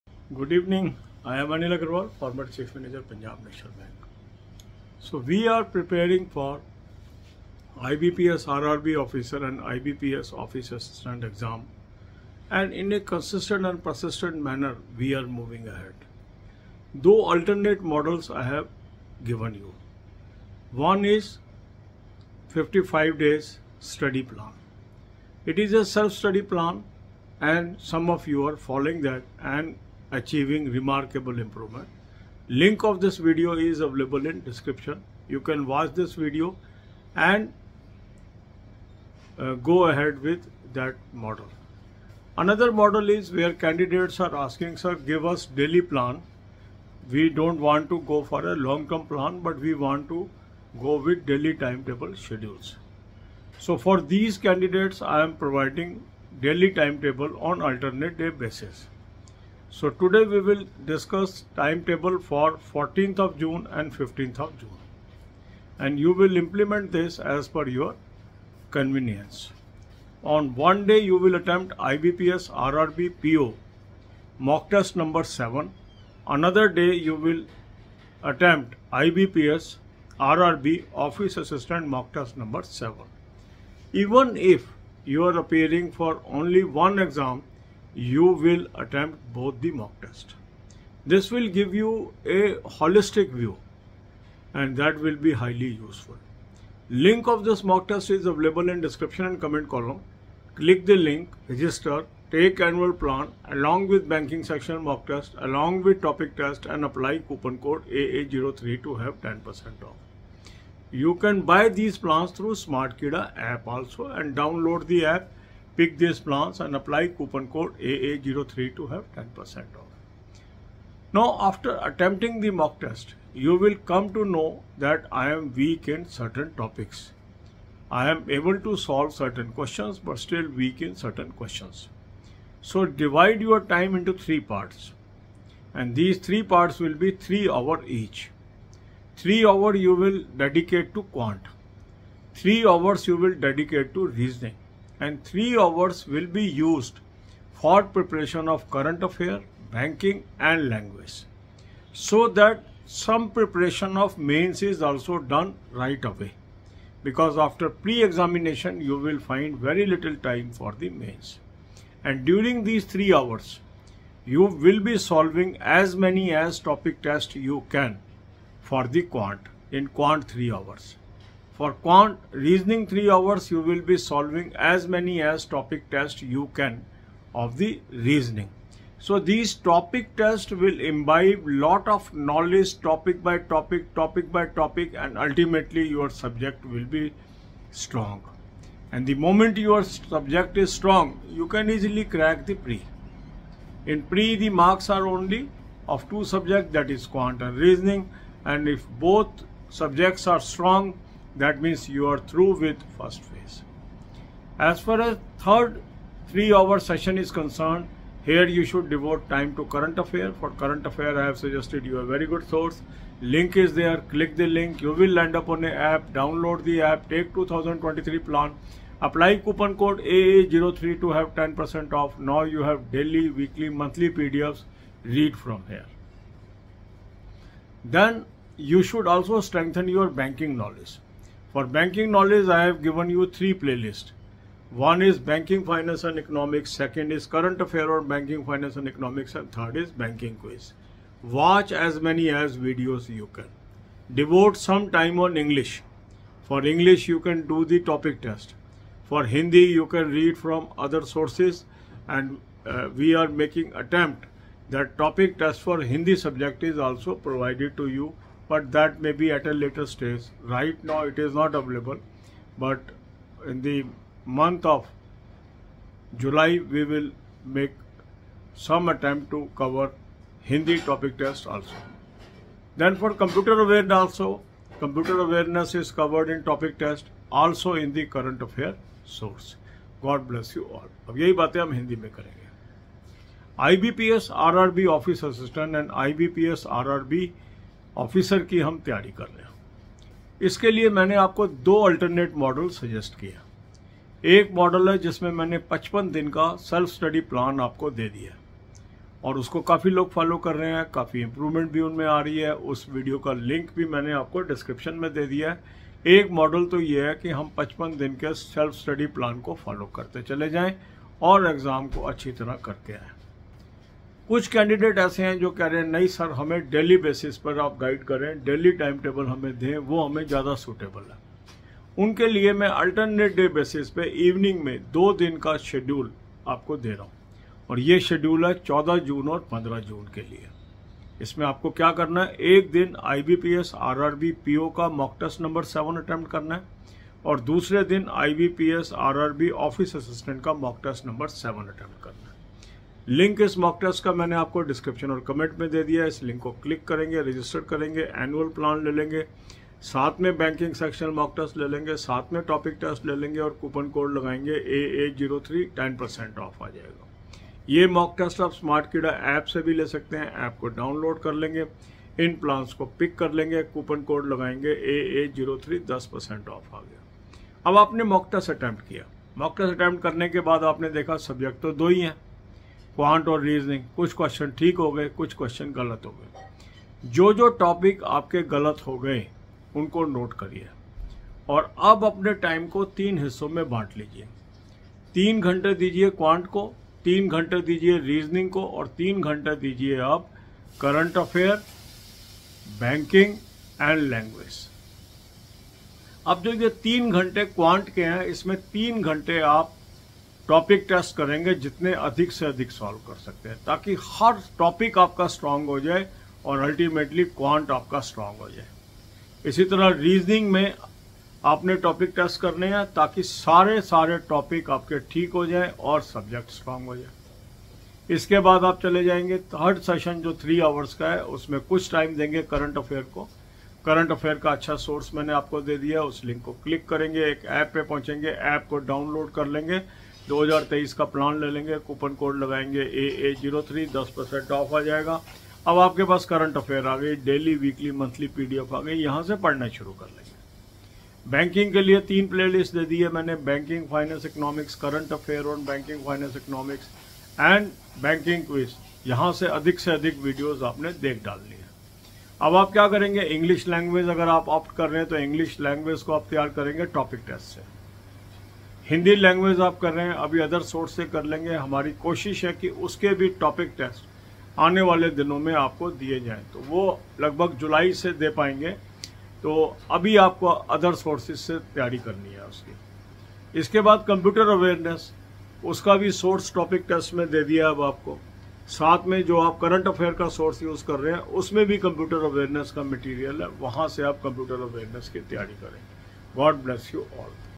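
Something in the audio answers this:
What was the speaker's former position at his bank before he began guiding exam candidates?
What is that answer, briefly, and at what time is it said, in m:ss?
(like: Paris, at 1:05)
Chief Manager, at 0:02.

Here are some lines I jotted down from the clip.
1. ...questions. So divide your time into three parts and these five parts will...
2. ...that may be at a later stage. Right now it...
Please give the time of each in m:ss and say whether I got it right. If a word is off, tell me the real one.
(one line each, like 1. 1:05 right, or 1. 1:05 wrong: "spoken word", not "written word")
1. 2:11 wrong: "three", not "five"
2. 4:18 right.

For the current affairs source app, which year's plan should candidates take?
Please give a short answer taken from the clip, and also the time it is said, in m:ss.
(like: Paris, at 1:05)
2023, at 3:37.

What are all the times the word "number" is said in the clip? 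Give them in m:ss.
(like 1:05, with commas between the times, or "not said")
1:14, 1:22.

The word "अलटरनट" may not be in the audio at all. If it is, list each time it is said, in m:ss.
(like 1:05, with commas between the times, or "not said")
4:51, 5:22.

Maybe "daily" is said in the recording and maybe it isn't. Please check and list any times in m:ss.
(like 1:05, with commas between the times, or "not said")
0:45, 0:51, 0:56, 3:42.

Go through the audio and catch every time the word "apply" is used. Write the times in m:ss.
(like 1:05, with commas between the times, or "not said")
1:46, 1:56, 3:39.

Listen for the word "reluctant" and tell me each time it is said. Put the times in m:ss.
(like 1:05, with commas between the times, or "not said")
not said.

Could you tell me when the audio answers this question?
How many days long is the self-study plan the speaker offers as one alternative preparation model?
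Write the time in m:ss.
0:22.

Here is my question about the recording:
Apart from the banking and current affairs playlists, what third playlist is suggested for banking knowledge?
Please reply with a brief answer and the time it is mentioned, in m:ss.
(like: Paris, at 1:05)
Banking quiz, at 3:59.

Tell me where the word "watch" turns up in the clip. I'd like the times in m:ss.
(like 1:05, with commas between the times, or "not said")
0:35, 4:01.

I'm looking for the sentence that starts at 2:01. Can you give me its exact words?
Now, after attempting the mock test, you will come to know that I am weak in certain topics.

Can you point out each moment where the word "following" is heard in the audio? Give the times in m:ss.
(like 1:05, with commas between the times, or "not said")
0:28.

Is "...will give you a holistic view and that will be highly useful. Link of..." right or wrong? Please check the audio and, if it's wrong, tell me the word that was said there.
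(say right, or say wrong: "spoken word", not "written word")
right.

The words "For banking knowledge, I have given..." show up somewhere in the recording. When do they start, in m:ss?
3:51.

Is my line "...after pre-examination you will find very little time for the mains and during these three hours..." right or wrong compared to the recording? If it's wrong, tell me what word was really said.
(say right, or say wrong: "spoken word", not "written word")
right.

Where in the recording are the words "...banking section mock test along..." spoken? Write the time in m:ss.
1:44.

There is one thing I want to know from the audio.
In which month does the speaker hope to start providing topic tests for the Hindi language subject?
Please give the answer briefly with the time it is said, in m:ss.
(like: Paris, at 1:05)
July, at 4:24.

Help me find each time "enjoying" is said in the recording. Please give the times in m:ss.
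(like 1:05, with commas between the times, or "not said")
not said.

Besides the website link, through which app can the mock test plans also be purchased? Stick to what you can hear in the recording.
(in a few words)
Smartkeeda.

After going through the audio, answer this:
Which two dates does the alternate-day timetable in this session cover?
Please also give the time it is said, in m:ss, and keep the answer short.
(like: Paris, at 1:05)
14th and 15th June, at 1:02.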